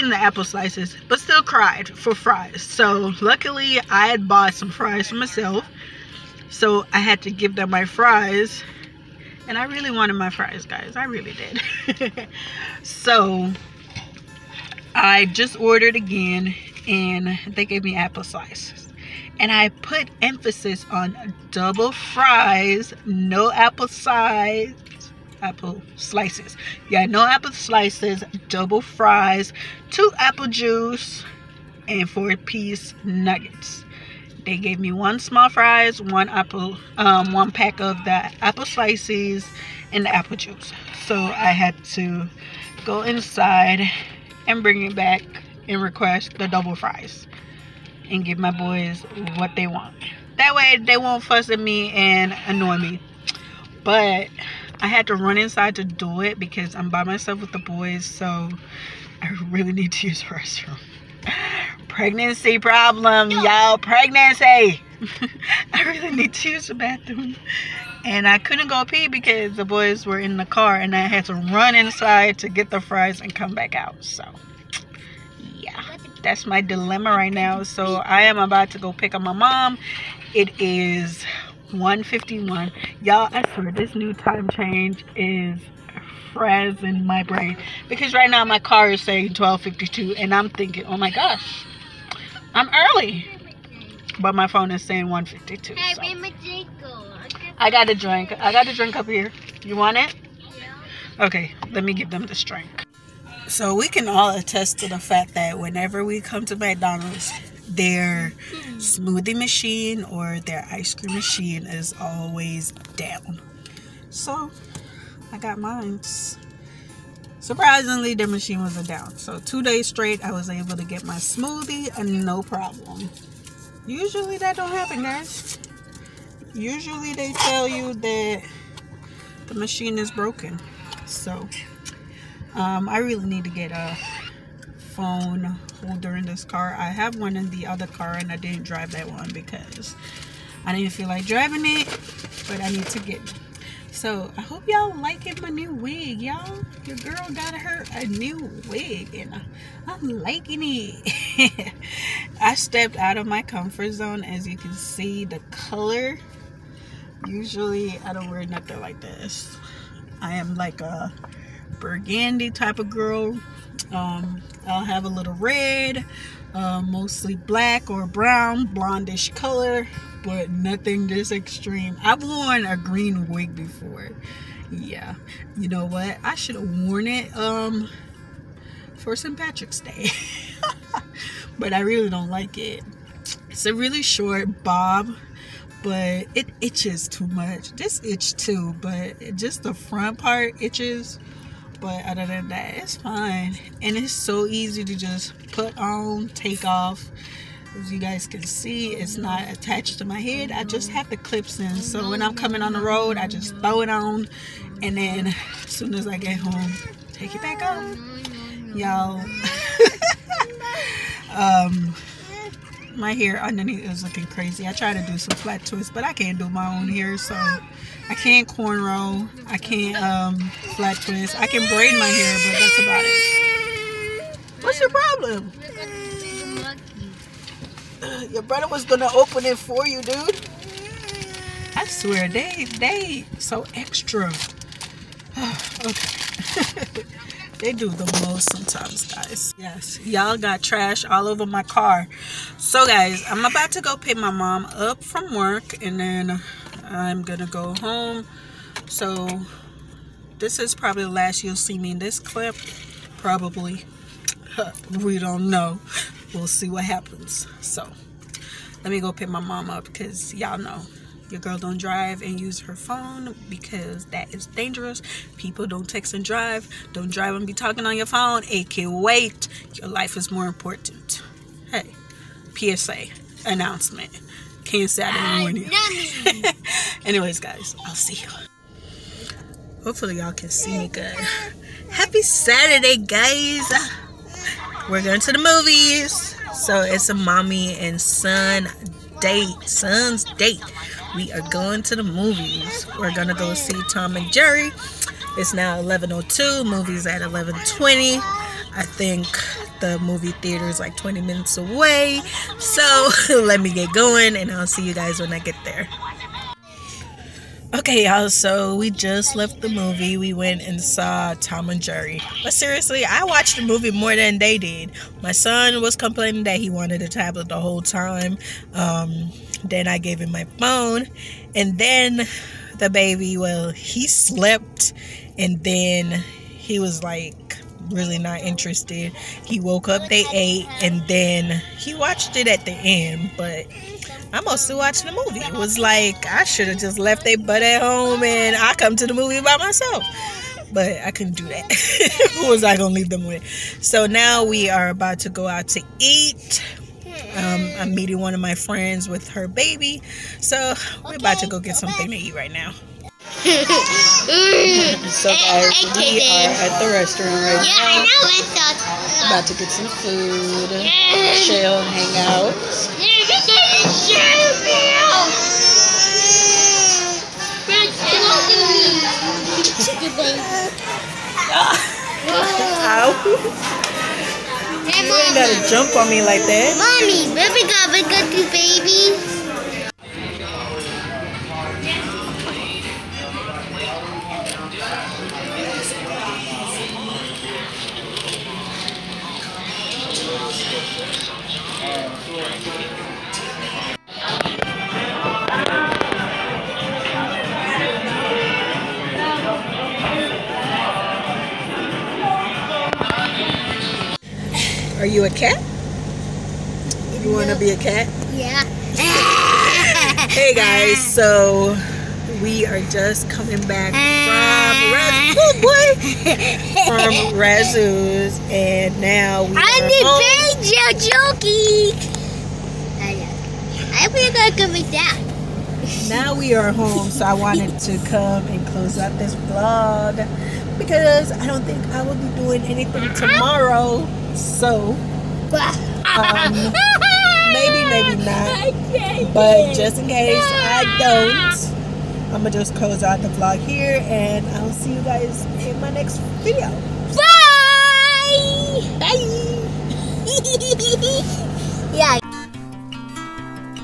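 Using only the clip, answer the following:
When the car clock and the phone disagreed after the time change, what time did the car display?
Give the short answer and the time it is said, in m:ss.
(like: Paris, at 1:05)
12:52, at 1:29.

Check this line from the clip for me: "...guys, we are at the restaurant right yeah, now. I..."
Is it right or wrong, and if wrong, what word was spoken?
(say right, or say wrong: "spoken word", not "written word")
right.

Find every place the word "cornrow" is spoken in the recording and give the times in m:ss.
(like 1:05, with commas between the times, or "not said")
3:38.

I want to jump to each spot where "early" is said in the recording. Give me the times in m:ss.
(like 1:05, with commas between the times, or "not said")
1:32.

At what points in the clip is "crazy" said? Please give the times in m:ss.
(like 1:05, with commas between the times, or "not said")
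3:34.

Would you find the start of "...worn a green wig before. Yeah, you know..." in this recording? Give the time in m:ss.
2:52.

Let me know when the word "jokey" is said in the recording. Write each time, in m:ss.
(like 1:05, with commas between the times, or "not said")
7:01.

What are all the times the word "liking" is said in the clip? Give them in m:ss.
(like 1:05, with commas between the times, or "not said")
2:24, 2:30.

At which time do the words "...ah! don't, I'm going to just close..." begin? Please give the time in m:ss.
7:20.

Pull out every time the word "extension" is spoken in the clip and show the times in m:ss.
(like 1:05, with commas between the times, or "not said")
not said.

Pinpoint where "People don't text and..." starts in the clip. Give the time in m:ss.
4:25.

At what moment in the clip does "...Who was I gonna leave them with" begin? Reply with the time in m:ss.
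5:42.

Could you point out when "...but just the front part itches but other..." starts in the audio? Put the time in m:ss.
3:08.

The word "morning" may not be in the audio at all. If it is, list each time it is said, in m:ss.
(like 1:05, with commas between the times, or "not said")
4:35.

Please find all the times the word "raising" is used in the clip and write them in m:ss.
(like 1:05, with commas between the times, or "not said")
not said.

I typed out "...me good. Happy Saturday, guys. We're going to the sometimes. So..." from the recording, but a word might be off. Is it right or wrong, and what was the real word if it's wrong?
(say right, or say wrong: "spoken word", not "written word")
wrong: "movies", not "sometimes".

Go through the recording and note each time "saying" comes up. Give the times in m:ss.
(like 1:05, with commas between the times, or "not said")
1:29, 1:34.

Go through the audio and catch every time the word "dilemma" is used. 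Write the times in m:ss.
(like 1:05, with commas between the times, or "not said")
1:16.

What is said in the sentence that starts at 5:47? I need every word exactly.
Um, I'm meeting one of my friends with her baby.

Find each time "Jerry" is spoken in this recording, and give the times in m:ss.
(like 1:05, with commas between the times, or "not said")
4:54, 5:11.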